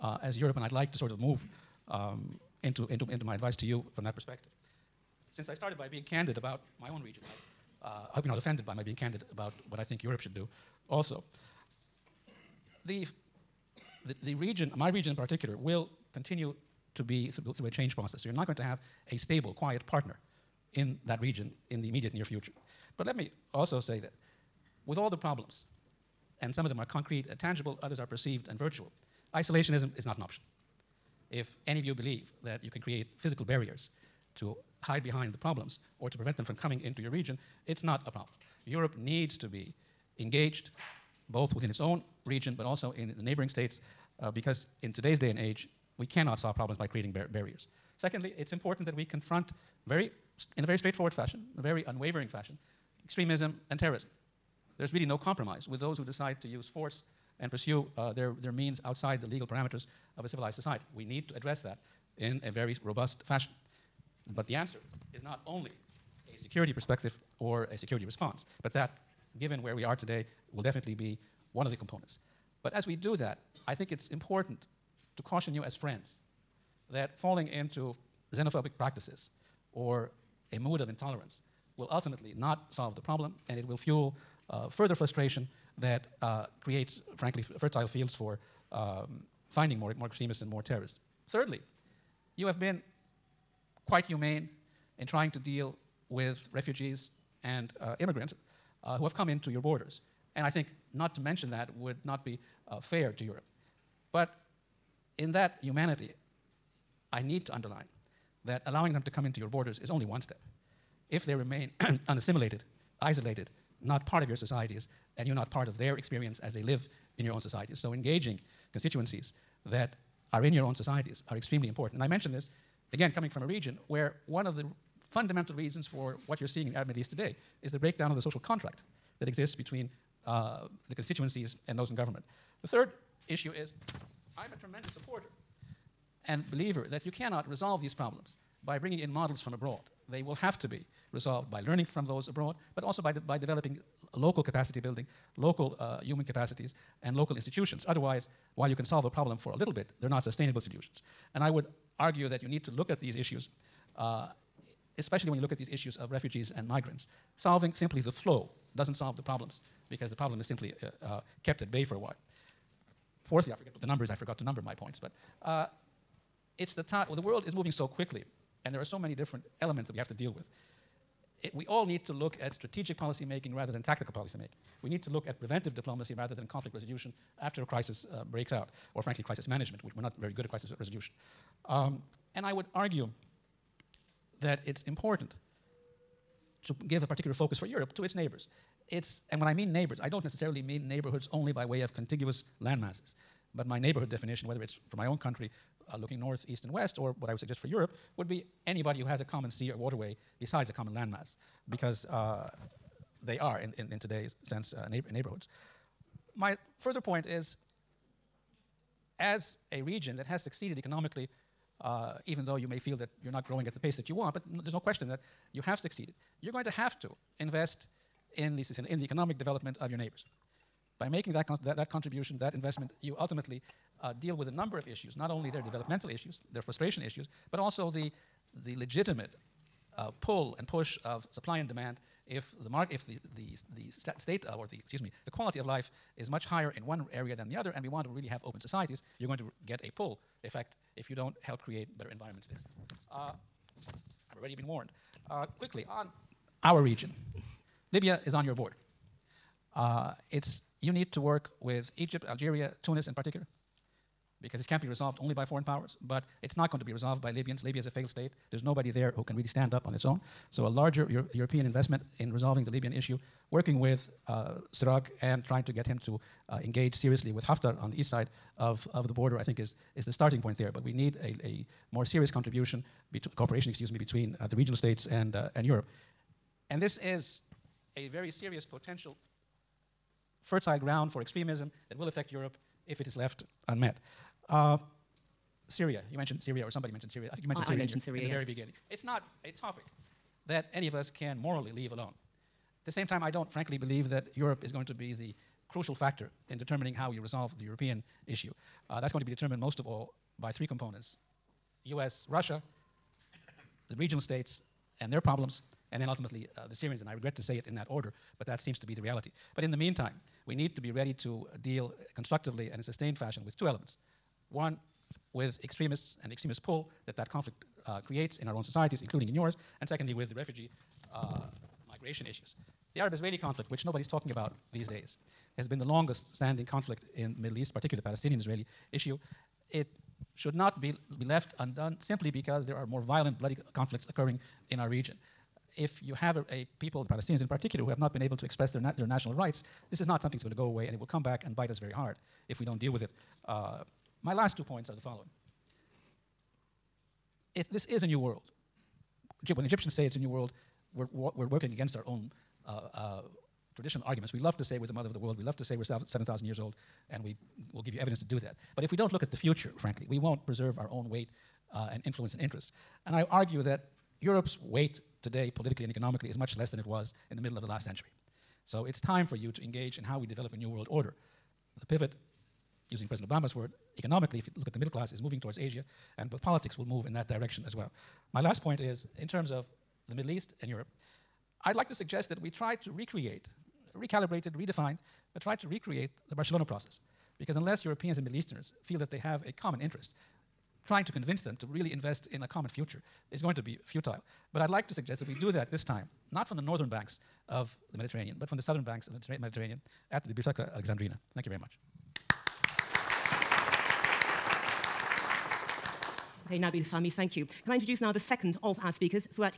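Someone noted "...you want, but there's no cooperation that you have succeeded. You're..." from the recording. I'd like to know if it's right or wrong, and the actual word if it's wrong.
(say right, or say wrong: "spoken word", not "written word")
wrong: "question", not "cooperation".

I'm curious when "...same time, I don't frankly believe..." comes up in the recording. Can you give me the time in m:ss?
4:52.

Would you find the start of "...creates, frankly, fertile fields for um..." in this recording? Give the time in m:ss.
1:26.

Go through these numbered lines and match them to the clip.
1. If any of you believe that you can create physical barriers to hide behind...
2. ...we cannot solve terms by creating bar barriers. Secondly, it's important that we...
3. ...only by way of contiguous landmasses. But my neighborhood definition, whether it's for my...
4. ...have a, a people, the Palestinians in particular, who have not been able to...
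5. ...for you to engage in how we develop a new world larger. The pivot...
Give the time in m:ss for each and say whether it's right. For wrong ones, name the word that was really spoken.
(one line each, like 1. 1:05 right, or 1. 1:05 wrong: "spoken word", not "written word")
1. 0:31 right
2. 0:45 wrong: "problems", not "terms"
3. 3:11 right
4. 5:36 right
5. 6:09 wrong: "order", not "larger".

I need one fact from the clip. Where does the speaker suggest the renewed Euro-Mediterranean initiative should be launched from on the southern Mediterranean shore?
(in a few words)
Biblioteca Alexandrina.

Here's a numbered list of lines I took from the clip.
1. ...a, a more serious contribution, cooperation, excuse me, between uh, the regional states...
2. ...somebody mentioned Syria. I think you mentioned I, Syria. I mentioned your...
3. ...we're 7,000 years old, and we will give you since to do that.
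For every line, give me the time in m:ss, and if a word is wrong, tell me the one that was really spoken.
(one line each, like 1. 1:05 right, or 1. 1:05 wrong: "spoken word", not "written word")
1. 4:31 right
2. 4:46 right
3. 5:55 wrong: "evidence", not "since".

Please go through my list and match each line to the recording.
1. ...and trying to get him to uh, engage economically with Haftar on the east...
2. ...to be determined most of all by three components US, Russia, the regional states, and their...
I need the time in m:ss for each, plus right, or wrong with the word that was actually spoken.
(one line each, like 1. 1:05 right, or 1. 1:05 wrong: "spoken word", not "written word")
1. 4:25 wrong: "seriously", not "economically"
2. 4:59 right.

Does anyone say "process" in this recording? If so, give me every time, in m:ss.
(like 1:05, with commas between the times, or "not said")
0:17, 6:26.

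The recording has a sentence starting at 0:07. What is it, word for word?
I, uh, I hope you're not offended by my being candid about what I think Europe should do also.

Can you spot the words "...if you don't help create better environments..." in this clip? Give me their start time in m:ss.
4:00.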